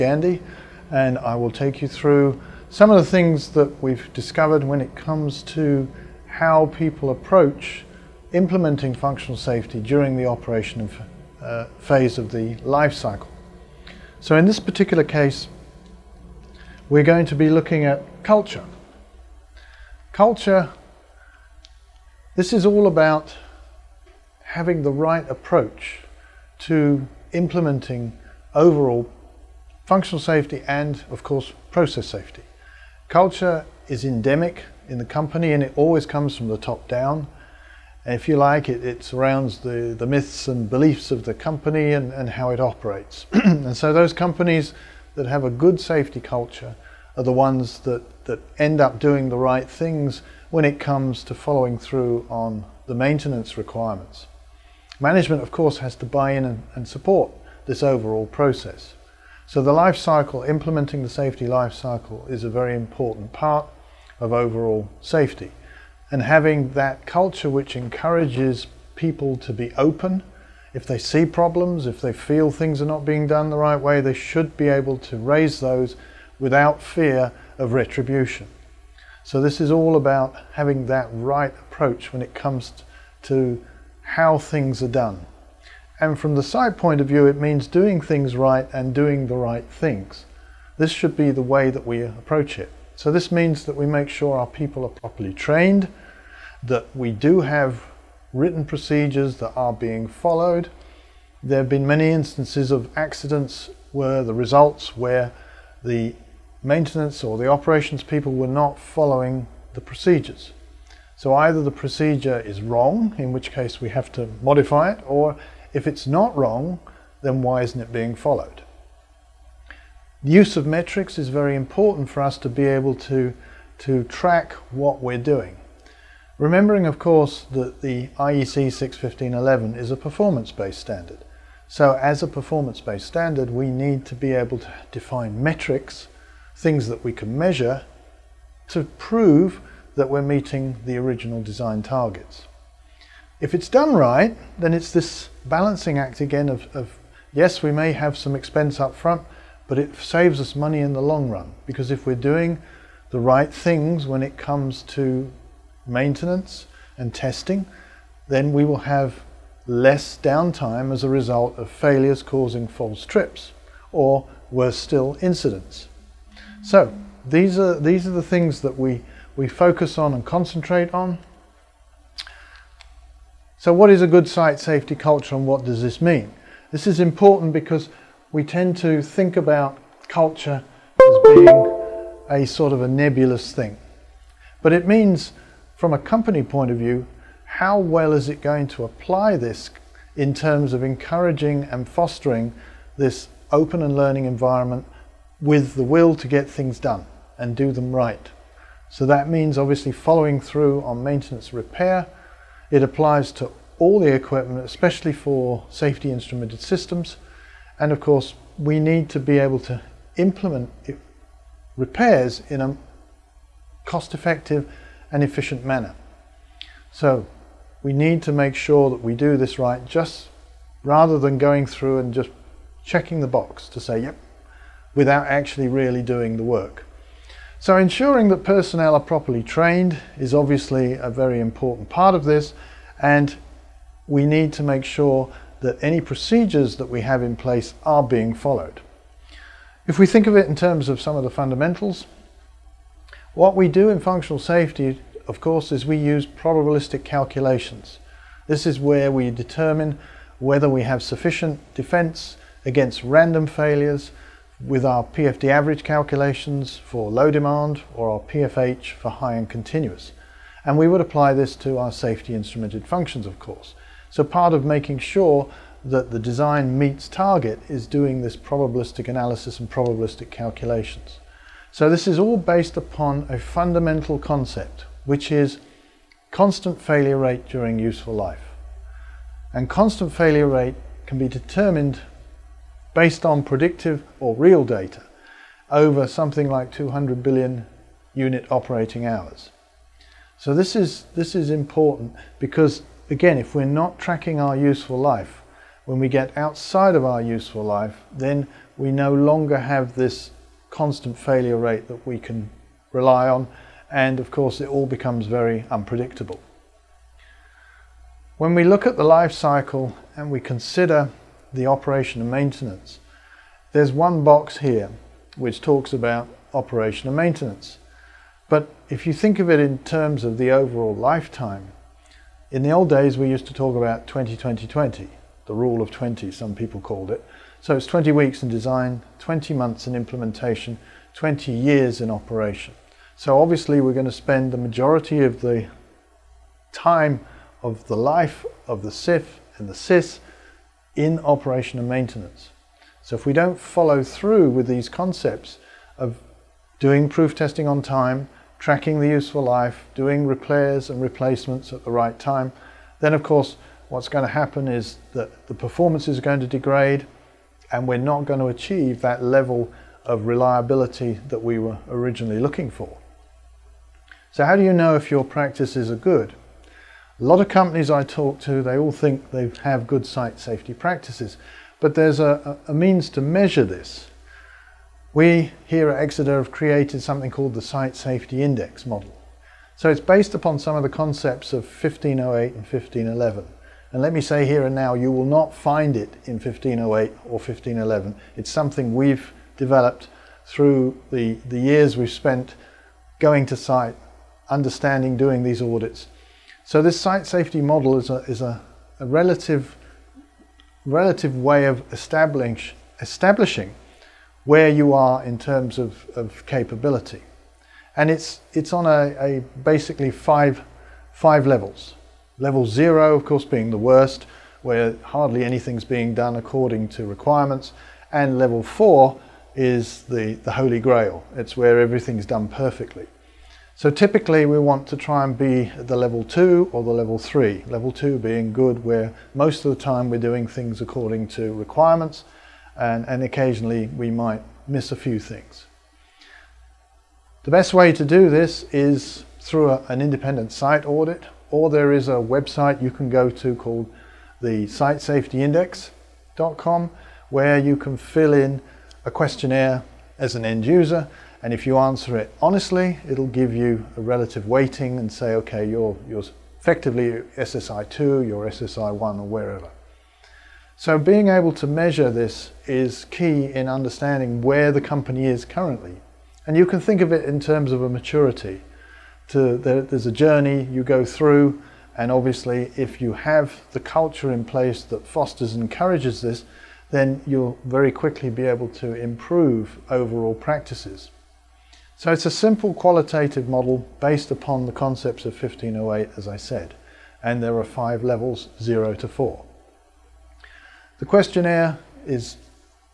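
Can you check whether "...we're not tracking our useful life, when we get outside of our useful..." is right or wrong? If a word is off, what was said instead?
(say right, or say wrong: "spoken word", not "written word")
right.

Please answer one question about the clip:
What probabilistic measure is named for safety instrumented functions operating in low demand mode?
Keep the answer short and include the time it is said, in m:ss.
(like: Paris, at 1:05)
PFD average, at 4:15.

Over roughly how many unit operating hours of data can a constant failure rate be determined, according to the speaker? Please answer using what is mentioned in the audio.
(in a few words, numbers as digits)
200 billion.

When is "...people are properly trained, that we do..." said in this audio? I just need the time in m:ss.
1:34.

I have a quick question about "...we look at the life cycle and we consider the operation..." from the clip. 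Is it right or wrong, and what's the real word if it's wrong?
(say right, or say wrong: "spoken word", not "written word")
right.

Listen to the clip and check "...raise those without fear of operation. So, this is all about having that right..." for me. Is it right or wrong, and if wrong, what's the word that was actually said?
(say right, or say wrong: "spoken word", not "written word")
wrong: "retribution", not "operation".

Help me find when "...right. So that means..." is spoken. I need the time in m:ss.
3:17.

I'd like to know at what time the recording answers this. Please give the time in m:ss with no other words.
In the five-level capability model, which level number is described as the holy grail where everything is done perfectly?
6:58.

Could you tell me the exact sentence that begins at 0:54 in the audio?
Management, of course, has to buy in and, and support this overall process.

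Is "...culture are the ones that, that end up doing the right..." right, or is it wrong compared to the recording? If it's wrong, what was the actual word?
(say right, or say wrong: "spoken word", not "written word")
right.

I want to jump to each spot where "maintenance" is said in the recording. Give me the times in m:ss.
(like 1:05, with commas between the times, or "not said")
0:52, 1:46, 2:35, 3:21, 5:12, 5:17, 5:41.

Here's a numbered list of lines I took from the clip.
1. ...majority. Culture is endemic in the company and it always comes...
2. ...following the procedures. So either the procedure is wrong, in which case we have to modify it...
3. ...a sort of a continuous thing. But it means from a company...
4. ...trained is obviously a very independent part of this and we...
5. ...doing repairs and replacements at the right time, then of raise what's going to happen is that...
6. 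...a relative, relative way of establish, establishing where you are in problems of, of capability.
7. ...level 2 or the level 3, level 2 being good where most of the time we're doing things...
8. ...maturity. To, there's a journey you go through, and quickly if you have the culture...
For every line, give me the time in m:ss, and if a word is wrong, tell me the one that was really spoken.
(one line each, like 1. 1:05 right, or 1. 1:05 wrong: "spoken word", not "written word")
1. 0:32 wrong: "safety", not "majority"
2. 1:48 right
3. 3:02 wrong: "nebulous", not "continuous"
4. 3:49 wrong: "important", not "independent"
5. 5:49 wrong: "course", not "raise"
6. 6:38 wrong: "terms", not "problems"
7. 7:05 right
8. 7:47 wrong: "obviously", not "quickly".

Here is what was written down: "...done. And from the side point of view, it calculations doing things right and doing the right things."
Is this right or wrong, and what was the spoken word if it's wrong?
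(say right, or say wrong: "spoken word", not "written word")
wrong: "means", not "calculations".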